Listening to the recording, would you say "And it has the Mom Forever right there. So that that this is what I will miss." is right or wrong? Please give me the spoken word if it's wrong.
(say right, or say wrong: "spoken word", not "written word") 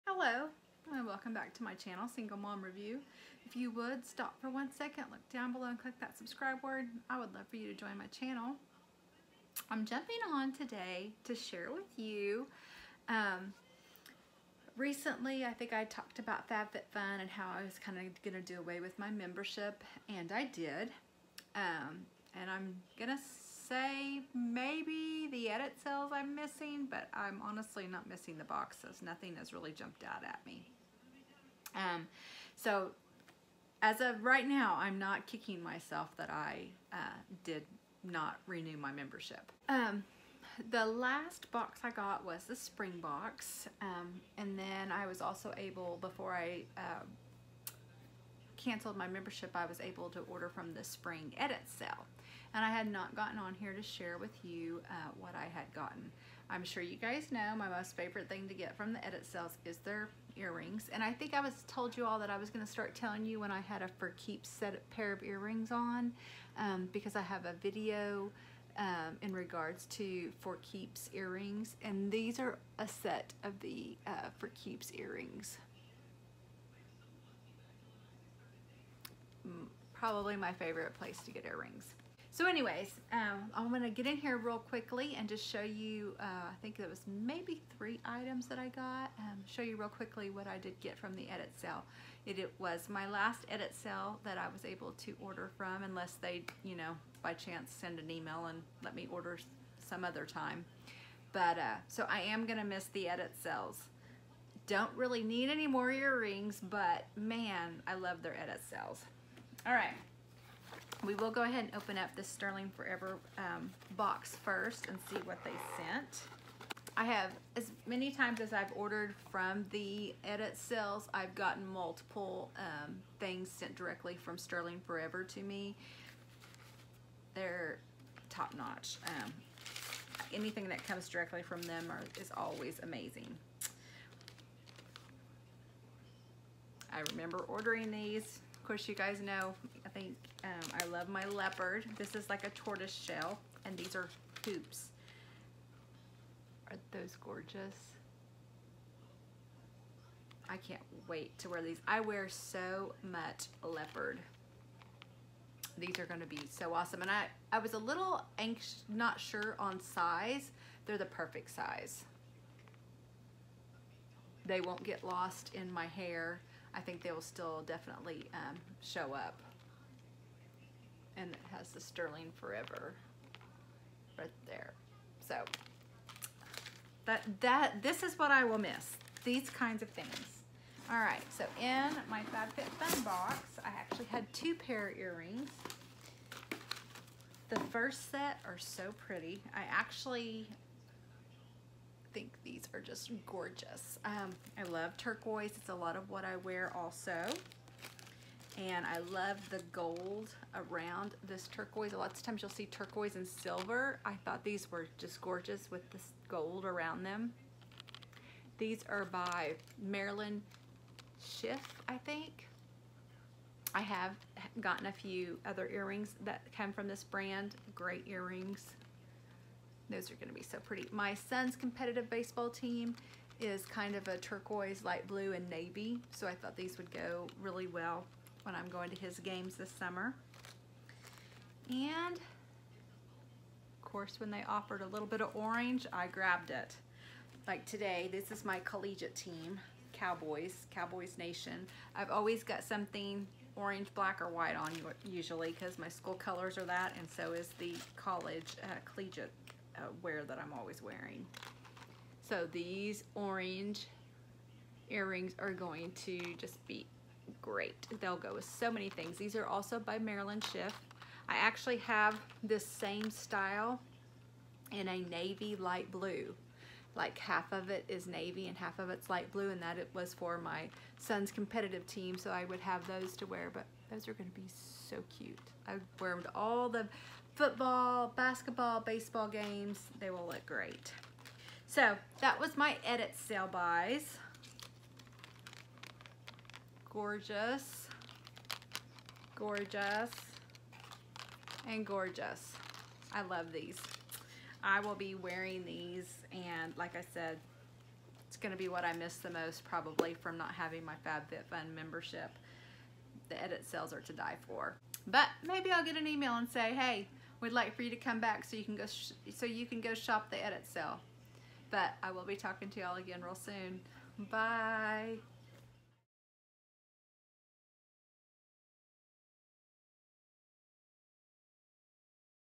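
wrong: "Sterling", not "Mom".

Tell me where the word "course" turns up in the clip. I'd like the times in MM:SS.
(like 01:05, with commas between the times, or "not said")
02:18, 03:53.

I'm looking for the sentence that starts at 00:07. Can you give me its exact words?
I would love for you to join my channel.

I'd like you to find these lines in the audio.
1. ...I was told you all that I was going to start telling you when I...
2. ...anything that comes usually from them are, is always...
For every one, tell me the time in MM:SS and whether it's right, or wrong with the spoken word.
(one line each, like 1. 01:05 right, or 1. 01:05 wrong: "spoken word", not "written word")
1. 01:01 right
2. 02:10 wrong: "directly", not "usually".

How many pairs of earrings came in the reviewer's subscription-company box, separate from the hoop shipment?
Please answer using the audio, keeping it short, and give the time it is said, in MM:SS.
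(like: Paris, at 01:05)
2, at 03:04.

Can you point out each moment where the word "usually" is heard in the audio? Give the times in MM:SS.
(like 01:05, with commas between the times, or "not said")
04:05.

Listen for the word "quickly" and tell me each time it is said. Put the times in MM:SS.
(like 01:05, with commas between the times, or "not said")
01:24, 01:29.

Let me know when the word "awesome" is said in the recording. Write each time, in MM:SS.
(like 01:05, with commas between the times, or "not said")
02:36.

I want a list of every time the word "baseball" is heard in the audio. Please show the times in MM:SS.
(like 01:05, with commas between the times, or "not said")
03:42, 04:38.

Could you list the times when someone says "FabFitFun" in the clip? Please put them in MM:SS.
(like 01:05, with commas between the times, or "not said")
00:16, 03:02, 05:01.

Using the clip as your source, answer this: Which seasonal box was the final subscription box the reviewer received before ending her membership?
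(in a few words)
Spring box.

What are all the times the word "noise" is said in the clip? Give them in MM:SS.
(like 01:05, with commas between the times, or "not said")
not said.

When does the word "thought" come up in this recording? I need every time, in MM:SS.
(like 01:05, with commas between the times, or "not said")
03:24, 03:46.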